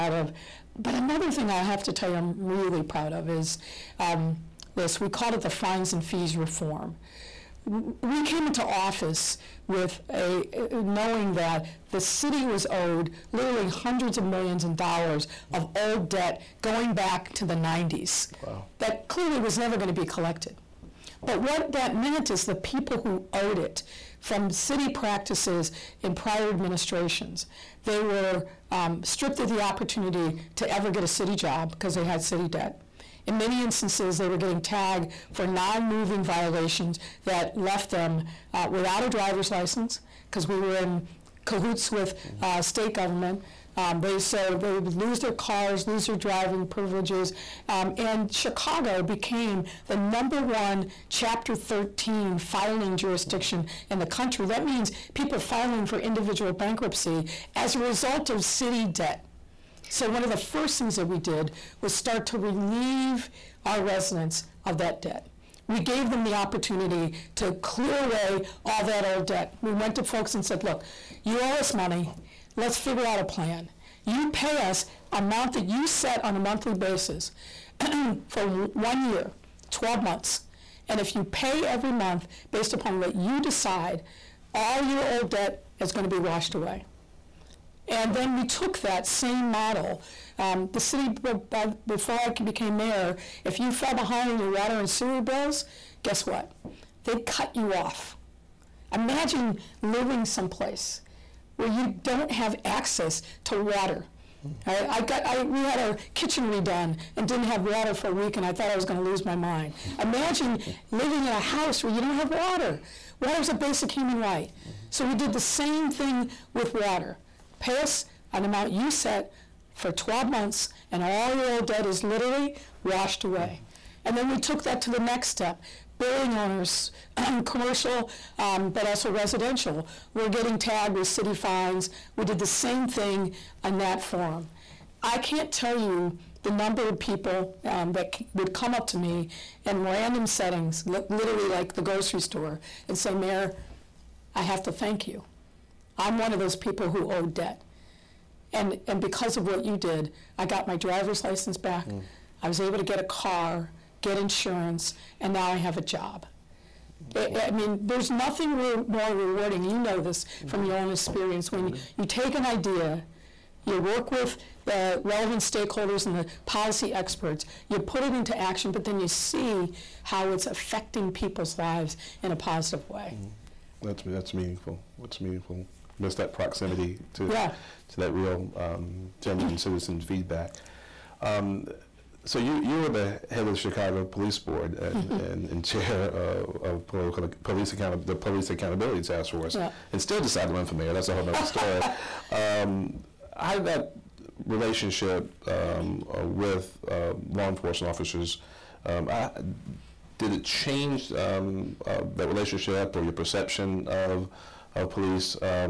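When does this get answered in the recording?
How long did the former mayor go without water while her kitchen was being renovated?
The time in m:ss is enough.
1:48.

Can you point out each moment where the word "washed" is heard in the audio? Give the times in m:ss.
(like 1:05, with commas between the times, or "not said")
1:26, 2:02.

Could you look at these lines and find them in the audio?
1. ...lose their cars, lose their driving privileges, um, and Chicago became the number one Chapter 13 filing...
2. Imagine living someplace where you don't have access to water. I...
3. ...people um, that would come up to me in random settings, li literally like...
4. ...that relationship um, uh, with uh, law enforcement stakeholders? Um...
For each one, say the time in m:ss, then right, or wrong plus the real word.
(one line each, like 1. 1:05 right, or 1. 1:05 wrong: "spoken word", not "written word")
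1. 0:44 right
2. 1:38 right
3. 2:16 right
4. 3:13 wrong: "officers", not "stakeholders".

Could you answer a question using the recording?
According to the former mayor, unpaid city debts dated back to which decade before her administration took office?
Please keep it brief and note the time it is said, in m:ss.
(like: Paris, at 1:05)
the 90s, at 0:17.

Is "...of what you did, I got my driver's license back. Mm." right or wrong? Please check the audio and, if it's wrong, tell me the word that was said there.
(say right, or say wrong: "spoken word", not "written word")
right.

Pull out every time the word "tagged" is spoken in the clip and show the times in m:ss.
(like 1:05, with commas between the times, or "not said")
0:34, 2:10.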